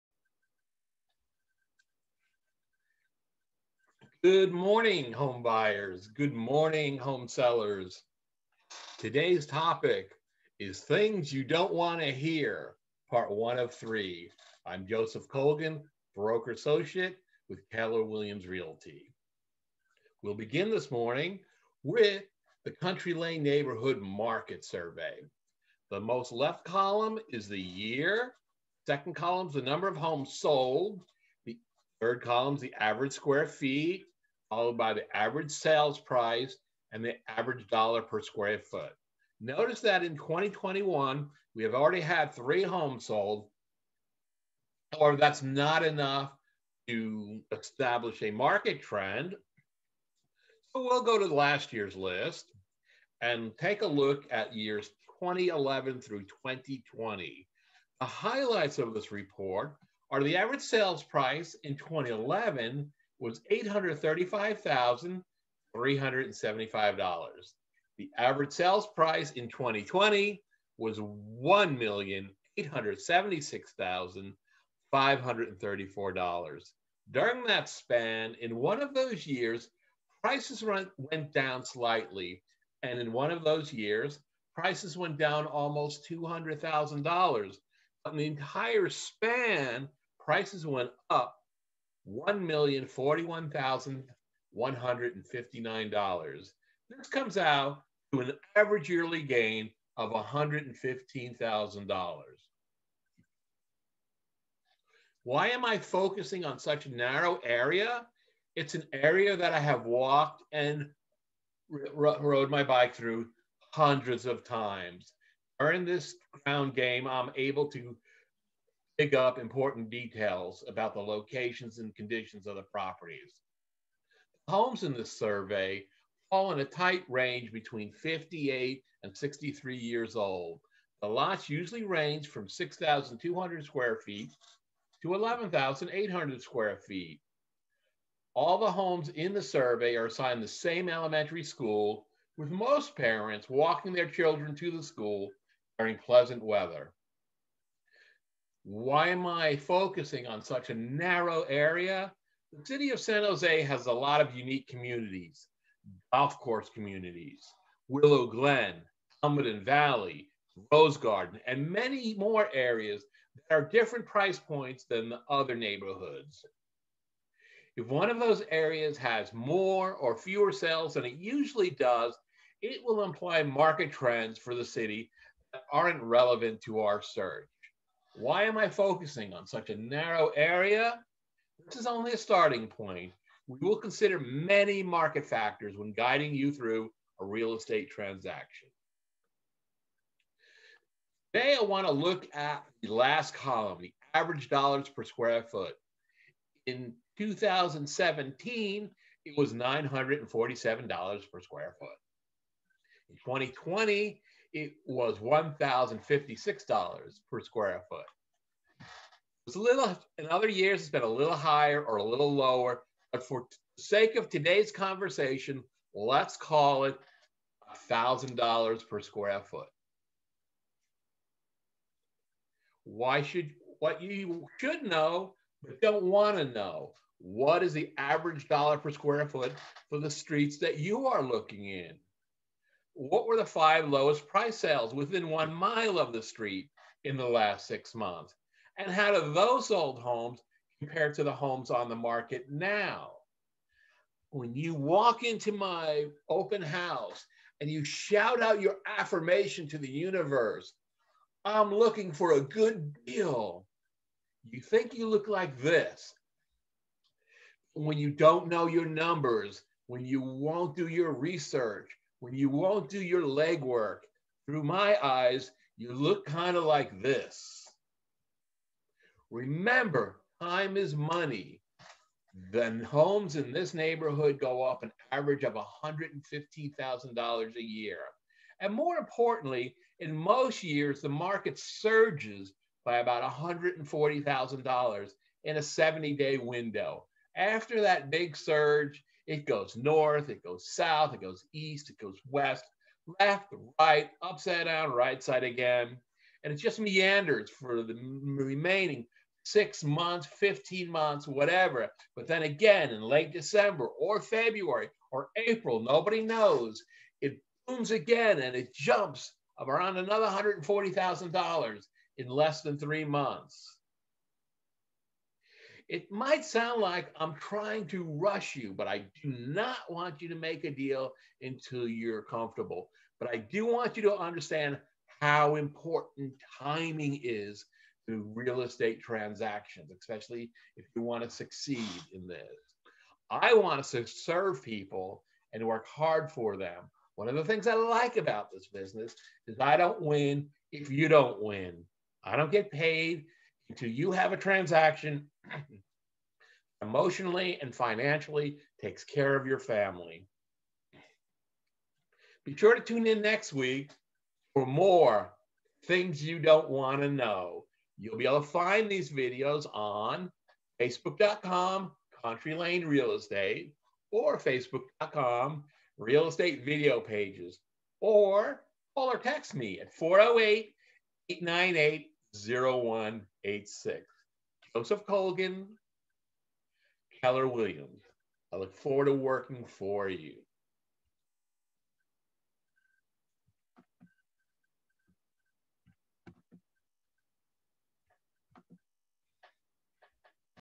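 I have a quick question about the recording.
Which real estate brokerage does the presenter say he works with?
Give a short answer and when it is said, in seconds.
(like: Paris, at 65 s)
Keller Williams Realty, at 17 s.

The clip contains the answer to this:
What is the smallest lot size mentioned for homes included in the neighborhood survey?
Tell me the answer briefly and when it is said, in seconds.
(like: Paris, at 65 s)
6,200 square feet, at 132 s.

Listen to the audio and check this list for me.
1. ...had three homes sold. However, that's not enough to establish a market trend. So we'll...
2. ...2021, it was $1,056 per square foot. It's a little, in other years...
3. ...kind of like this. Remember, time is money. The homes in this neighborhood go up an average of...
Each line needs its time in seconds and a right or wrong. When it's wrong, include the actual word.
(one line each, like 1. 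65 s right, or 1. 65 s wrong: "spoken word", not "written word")
1. 42 s right
2. 203 s wrong: "2020", not "2021"
3. 266 s right.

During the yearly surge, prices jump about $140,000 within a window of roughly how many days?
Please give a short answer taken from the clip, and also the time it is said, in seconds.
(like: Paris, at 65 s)
70 days, at 285 s.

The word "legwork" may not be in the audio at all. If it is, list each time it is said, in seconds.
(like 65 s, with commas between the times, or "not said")
263 s.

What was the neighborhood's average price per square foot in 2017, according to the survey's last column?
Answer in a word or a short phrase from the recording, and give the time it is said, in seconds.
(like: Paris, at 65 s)
$947, at 199 s.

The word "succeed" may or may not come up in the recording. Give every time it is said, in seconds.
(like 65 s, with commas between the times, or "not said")
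331 s.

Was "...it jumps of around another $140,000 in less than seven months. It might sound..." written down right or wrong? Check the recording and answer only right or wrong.
wrong.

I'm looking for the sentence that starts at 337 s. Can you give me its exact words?
One of the things I like about this business is I don't win if you don't win.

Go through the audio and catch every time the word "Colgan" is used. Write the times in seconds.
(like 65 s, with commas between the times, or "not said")
15 s, 375 s.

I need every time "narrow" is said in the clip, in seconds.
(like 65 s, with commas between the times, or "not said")
106 s, 150 s, 179 s.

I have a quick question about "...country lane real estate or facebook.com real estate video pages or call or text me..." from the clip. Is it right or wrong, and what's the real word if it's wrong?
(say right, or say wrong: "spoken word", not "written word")
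right.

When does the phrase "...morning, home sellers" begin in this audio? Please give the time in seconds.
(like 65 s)
6 s.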